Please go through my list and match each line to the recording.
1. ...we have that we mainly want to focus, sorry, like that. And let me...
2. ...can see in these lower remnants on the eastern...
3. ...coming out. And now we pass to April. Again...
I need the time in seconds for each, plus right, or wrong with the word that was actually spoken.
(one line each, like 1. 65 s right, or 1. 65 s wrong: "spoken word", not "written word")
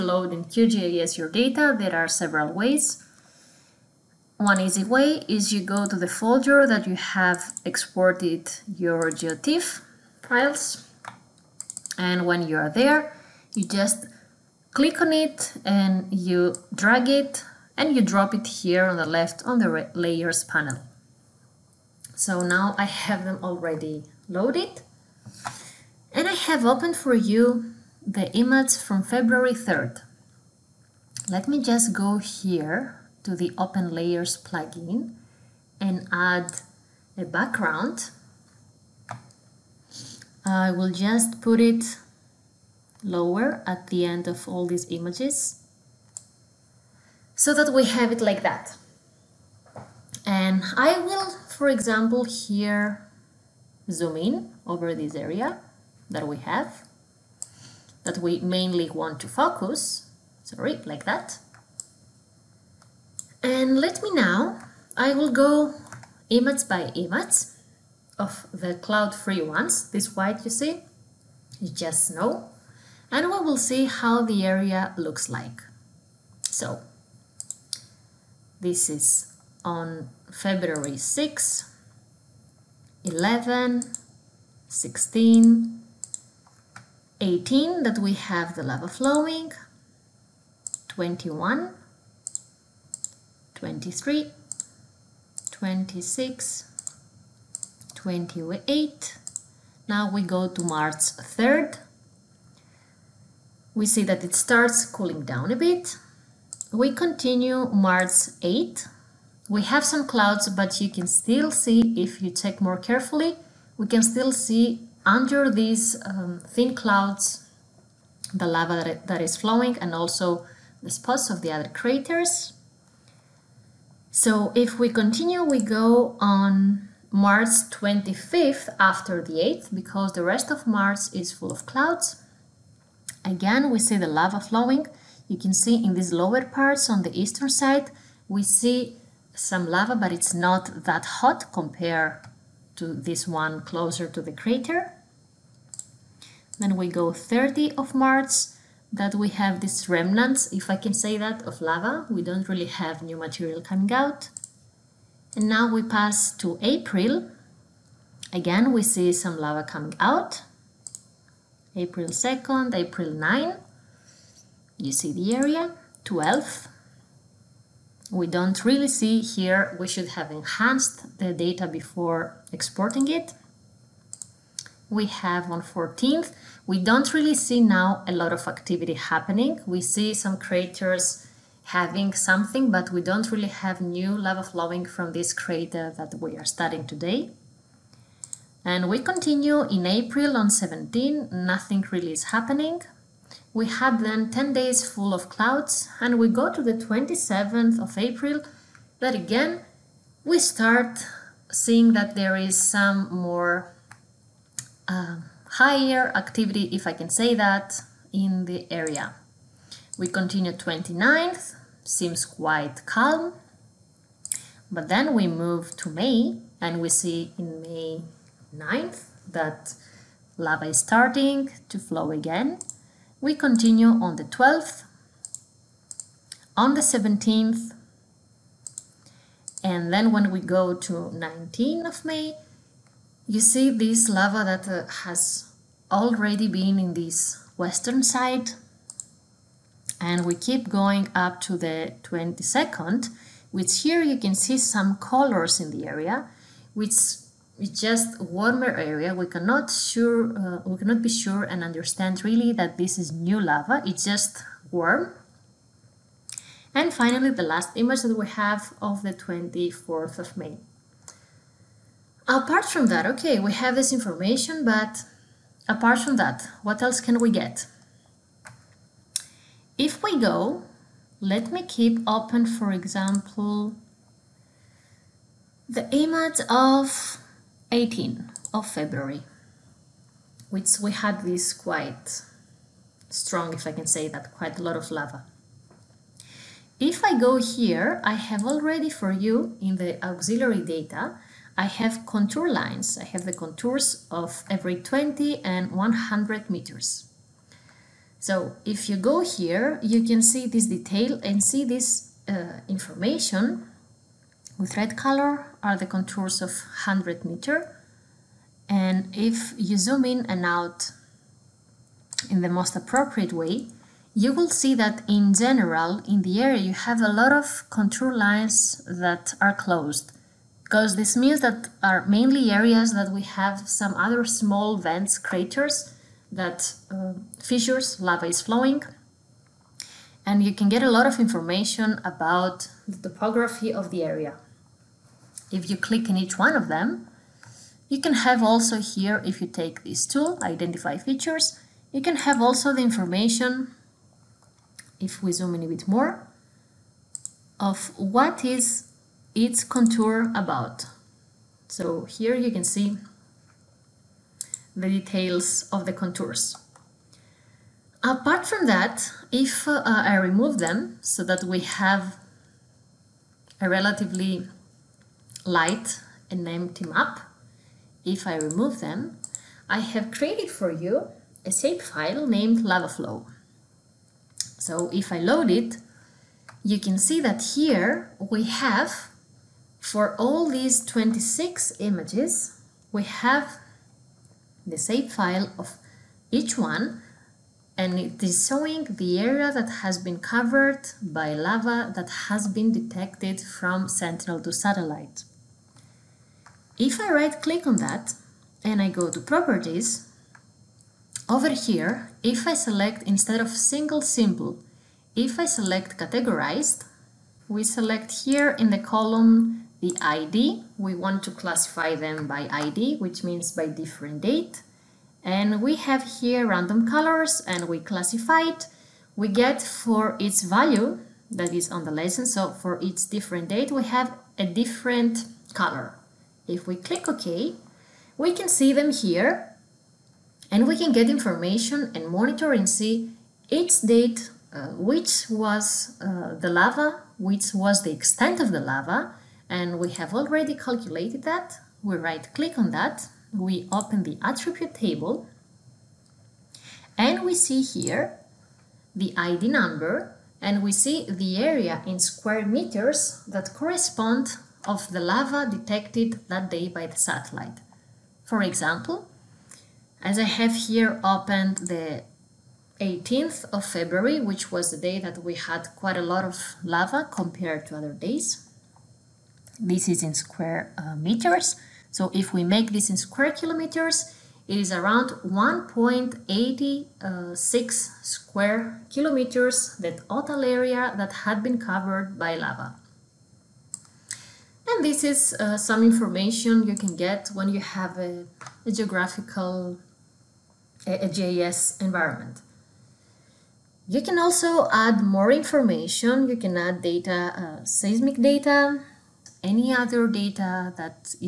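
1. 56 s right
2. 135 s wrong: "parts", not "remnants"
3. 153 s right.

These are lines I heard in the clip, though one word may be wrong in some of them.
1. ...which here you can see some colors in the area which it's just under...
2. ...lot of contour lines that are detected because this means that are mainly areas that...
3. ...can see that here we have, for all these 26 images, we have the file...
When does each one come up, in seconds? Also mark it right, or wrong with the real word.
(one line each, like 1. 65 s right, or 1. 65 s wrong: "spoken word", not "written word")
1. 243 s wrong: "warmer", not "under"
2. 317 s wrong: "closed", not "detected"
3. 376 s right.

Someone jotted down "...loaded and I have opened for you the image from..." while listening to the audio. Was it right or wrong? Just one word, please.
right.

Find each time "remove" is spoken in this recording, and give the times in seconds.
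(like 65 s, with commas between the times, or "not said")
360 s, 368 s.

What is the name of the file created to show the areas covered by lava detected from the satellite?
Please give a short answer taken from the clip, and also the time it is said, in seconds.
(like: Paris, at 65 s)
LavaFlow, at 372 s.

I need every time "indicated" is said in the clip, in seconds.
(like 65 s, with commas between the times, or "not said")
not said.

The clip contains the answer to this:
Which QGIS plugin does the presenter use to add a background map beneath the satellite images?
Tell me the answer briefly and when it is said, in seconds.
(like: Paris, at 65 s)
Open Layers, at 33 s.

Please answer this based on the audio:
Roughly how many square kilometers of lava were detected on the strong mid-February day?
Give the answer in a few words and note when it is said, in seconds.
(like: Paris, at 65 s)
1.86, at 475 s.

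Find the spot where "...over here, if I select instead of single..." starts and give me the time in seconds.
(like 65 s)
401 s.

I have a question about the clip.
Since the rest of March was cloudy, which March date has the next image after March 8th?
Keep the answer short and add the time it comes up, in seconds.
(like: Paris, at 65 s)
March 25, at 127 s.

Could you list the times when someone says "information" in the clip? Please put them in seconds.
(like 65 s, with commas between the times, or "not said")
263 s, 302 s, 331 s, 342 s, 431 s, 485 s, 495 s.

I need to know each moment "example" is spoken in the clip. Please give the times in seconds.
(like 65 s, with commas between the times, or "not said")
51 s, 272 s, 458 s.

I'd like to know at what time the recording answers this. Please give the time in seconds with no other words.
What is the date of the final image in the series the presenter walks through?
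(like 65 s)
259 s.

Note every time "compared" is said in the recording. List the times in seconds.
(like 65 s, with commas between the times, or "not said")
141 s, 467 s.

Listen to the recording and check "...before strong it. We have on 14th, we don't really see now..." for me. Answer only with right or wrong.
wrong.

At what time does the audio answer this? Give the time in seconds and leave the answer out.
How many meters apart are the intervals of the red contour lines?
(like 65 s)
306 s.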